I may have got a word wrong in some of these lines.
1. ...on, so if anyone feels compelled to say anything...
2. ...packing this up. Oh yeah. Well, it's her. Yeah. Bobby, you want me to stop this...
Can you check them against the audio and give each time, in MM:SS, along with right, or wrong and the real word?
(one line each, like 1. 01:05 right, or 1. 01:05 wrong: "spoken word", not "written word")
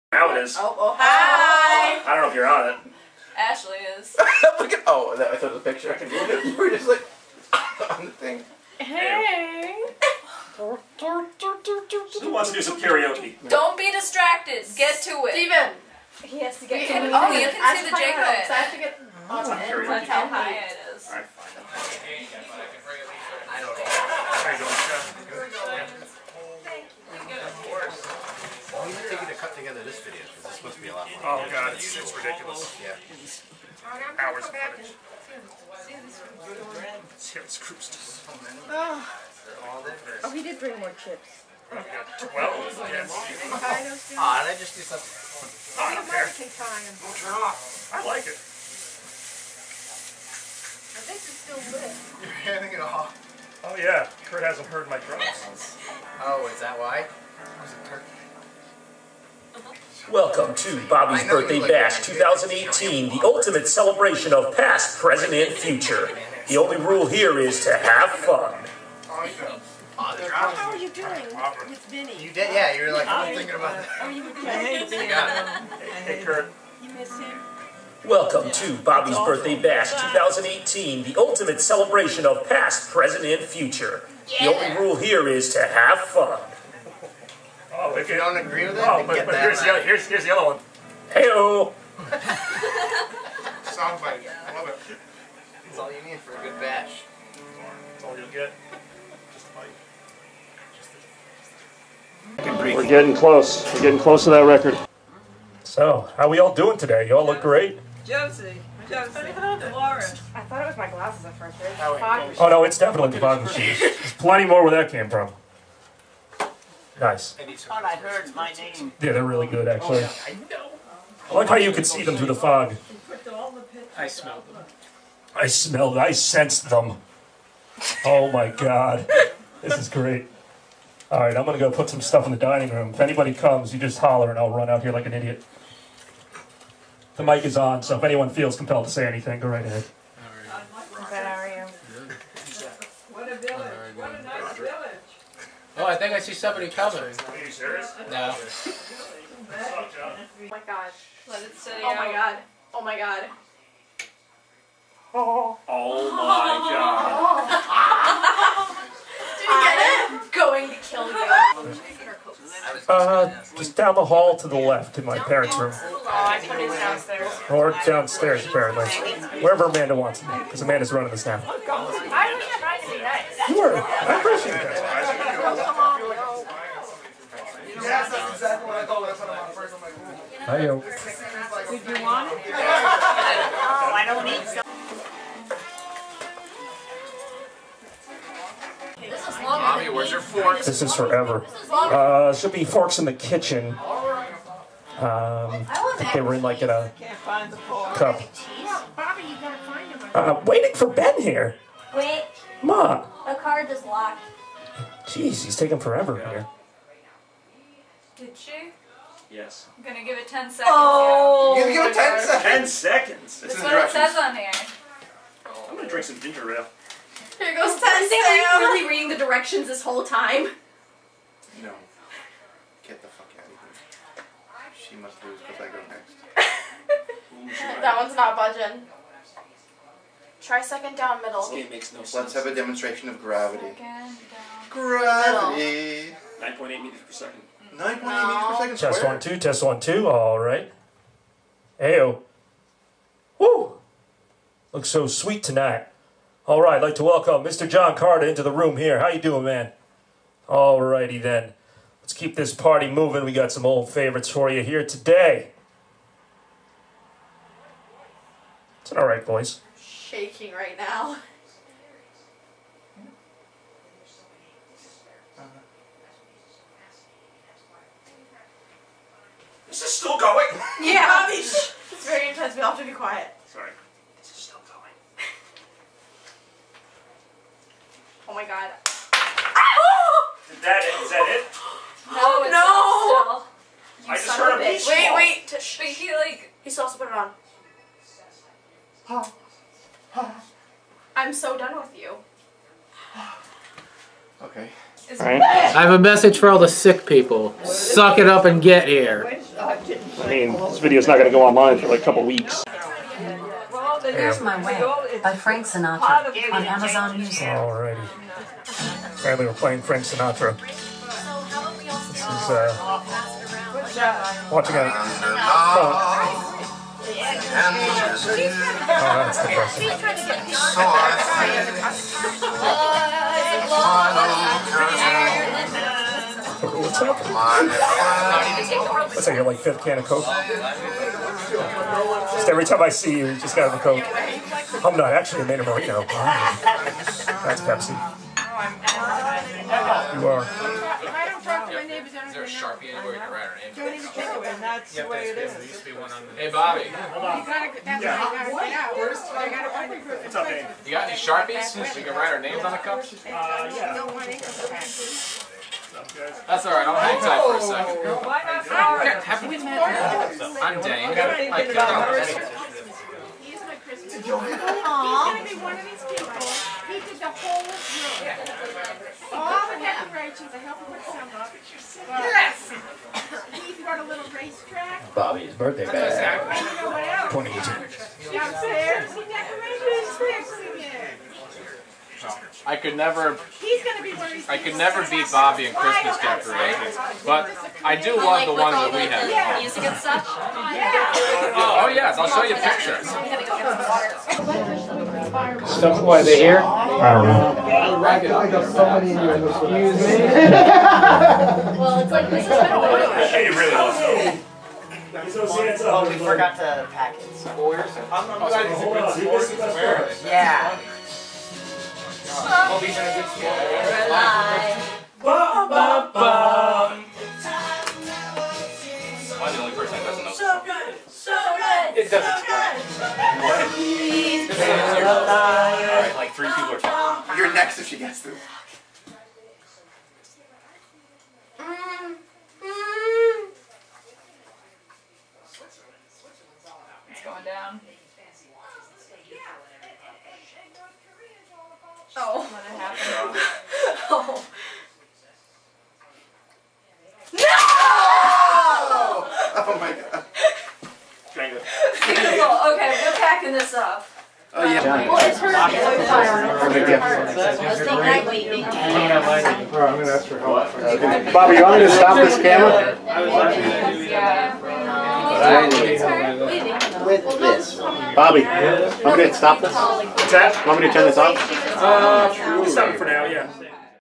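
1. 02:17 right
2. 07:33 right.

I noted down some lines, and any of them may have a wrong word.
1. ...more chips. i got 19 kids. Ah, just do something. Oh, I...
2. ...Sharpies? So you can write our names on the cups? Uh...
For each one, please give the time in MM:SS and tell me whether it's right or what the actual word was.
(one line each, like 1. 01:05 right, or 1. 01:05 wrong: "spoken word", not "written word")
1. 00:40 wrong: "12", not "19"
2. 05:51 right.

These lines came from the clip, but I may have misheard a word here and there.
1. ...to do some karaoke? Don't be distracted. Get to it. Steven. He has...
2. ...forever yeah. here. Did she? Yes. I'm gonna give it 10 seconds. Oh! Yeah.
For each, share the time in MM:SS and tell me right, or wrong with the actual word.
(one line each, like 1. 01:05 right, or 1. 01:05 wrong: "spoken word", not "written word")
1. 00:12 right
2. 03:25 right.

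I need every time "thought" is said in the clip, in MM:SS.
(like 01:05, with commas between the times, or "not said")
00:05, 01:50, 02:58.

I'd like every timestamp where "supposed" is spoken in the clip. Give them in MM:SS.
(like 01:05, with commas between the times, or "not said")
04:46.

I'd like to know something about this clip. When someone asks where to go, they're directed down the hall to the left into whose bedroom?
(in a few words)
parents' room.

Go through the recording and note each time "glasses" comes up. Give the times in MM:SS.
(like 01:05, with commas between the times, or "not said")
01:50.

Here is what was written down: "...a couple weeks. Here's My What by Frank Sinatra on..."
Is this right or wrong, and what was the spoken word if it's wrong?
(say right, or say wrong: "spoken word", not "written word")
wrong: "Way", not "What".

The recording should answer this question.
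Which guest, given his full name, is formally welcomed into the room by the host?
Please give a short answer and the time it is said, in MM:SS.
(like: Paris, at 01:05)
John Carter, at 04:07.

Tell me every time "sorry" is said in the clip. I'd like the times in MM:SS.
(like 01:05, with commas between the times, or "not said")
04:33, 05:58.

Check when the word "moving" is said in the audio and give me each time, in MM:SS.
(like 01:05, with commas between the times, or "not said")
04:12.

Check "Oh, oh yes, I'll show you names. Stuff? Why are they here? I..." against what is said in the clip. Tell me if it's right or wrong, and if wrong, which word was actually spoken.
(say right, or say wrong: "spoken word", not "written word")
wrong: "pictures", not "names".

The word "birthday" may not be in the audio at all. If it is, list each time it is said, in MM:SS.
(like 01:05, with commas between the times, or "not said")
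01:01, 01:19, 06:15.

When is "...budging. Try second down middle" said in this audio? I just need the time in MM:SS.
03:48.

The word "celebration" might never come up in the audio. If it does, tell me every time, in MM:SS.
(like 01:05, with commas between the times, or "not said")
01:03, 01:21.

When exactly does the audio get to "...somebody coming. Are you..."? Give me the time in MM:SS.
02:26.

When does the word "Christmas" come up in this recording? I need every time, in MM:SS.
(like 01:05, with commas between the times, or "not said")
06:03, 06:25.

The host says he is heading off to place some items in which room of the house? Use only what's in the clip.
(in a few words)
dining room.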